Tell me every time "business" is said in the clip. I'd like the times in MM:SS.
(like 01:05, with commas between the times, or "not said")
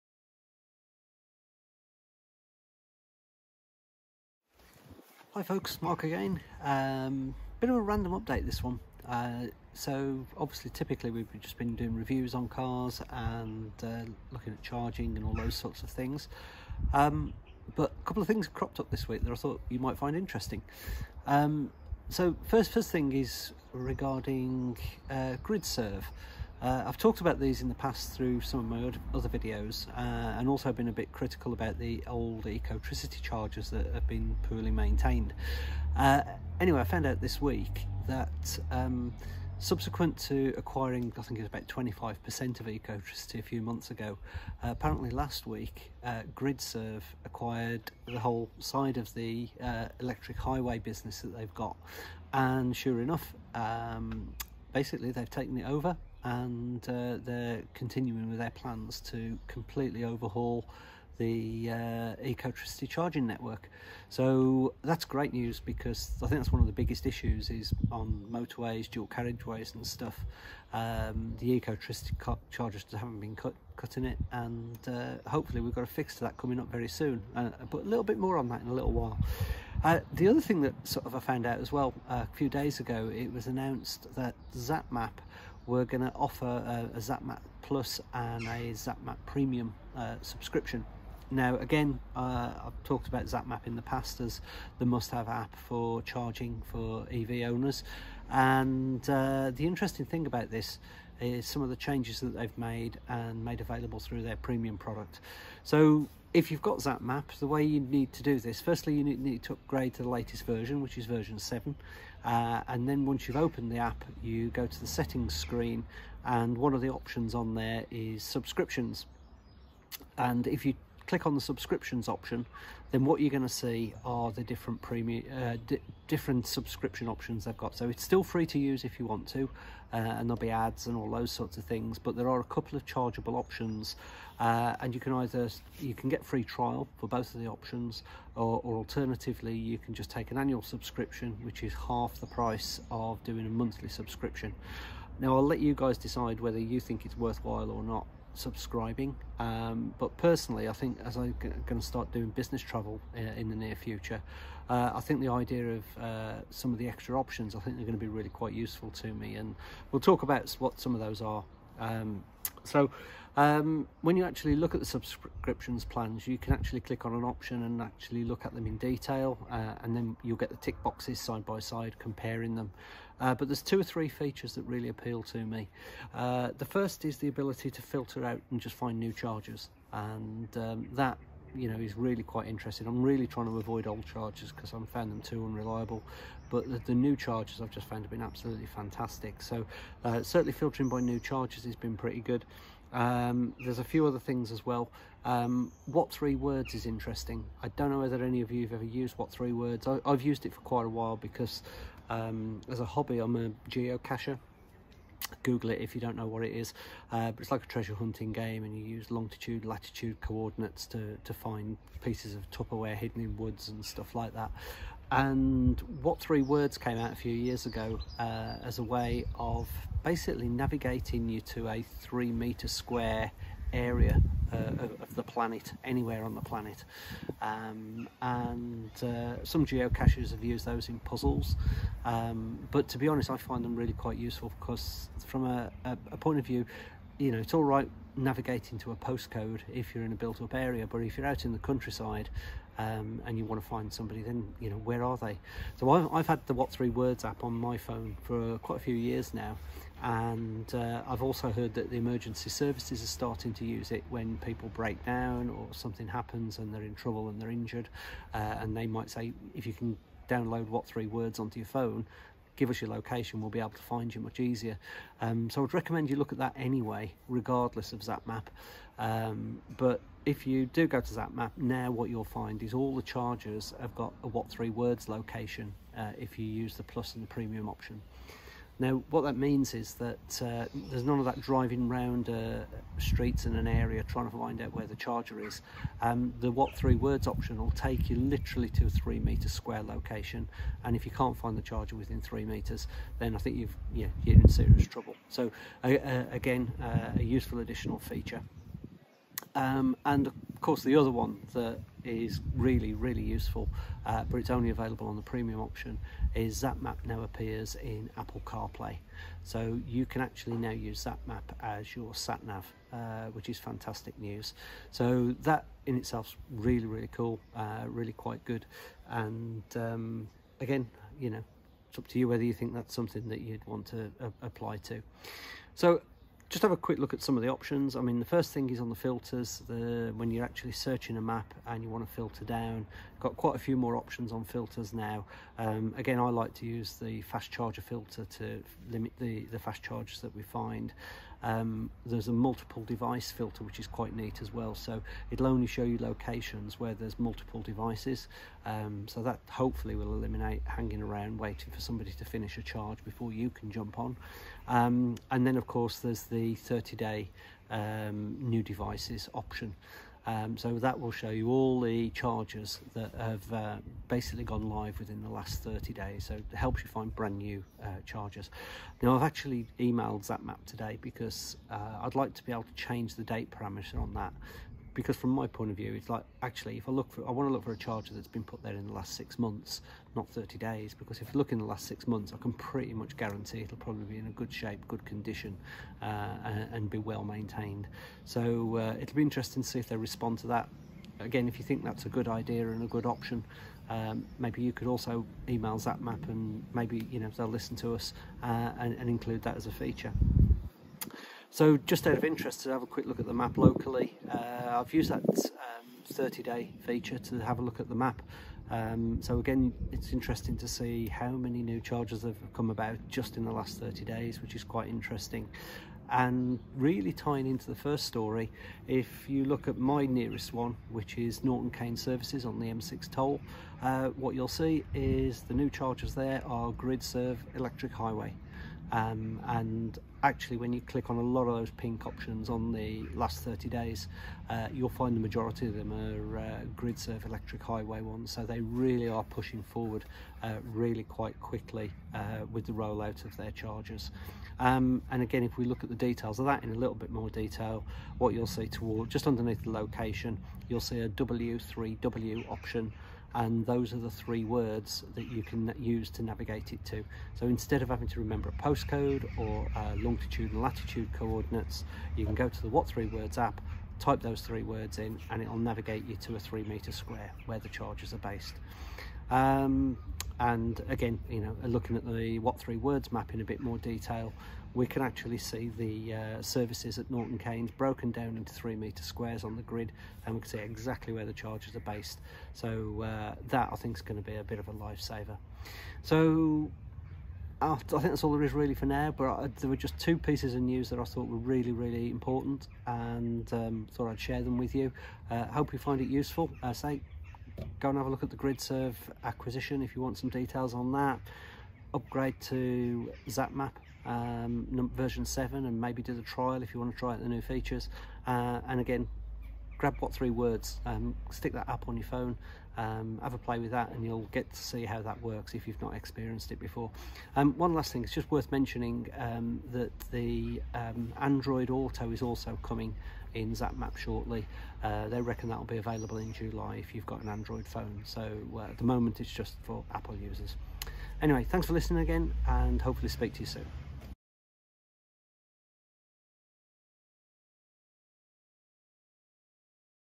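00:50, 02:32.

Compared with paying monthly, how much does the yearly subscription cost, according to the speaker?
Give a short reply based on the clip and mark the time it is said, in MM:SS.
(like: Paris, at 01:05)
Half the price, at 02:21.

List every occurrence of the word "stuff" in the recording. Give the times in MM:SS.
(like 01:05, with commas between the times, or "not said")
01:09, 03:33.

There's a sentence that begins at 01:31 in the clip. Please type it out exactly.
Now, again, uh, I've talked about ZapMap in the past as the must-have app for charging for EV owners.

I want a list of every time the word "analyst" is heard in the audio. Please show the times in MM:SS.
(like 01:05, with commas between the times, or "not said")
not said.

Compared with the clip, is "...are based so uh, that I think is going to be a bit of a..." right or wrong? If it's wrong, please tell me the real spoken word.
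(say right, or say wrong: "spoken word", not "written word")
right.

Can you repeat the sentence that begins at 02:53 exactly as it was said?
Uh, but there's two or three features that really appeal to me.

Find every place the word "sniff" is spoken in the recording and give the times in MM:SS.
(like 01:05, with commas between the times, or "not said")
not said.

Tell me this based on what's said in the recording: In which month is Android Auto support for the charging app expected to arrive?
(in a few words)
July.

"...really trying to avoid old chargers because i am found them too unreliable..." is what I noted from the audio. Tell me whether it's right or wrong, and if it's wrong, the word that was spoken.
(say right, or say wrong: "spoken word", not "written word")
right.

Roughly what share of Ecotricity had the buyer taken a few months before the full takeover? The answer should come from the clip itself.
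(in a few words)
25%.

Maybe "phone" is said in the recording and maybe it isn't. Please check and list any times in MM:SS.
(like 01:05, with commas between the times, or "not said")
04:07, 04:21, 08:32, 08:47.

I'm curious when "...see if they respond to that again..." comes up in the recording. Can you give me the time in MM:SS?
06:29.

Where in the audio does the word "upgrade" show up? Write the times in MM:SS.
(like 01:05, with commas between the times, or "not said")
01:49, 08:21.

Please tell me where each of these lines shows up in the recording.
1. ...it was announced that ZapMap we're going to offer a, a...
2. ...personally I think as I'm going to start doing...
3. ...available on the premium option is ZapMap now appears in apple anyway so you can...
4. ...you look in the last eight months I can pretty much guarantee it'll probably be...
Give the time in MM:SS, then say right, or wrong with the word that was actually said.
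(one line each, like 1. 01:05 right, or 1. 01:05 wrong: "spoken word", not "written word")
1. 01:23 right
2. 02:30 right
3. 05:04 wrong: "carplay", not "anyway"
4. 06:21 wrong: "six", not "eight".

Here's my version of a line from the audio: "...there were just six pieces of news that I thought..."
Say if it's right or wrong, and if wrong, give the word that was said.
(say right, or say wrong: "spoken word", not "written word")
wrong: "two", not "six".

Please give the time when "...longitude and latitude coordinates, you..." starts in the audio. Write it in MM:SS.
07:39.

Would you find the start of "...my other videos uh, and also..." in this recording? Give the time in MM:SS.
00:28.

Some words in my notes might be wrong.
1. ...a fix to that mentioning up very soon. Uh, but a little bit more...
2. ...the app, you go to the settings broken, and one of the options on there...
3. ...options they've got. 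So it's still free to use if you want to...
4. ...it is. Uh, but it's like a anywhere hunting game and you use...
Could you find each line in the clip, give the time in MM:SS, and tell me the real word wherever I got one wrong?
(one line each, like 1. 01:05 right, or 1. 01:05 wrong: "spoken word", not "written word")
1. 01:15 wrong: "coming", not "mentioning"
2. 01:53 wrong: "screen", not "broken"
3. 02:07 right
4. 03:26 wrong: "treasure", not "anywhere".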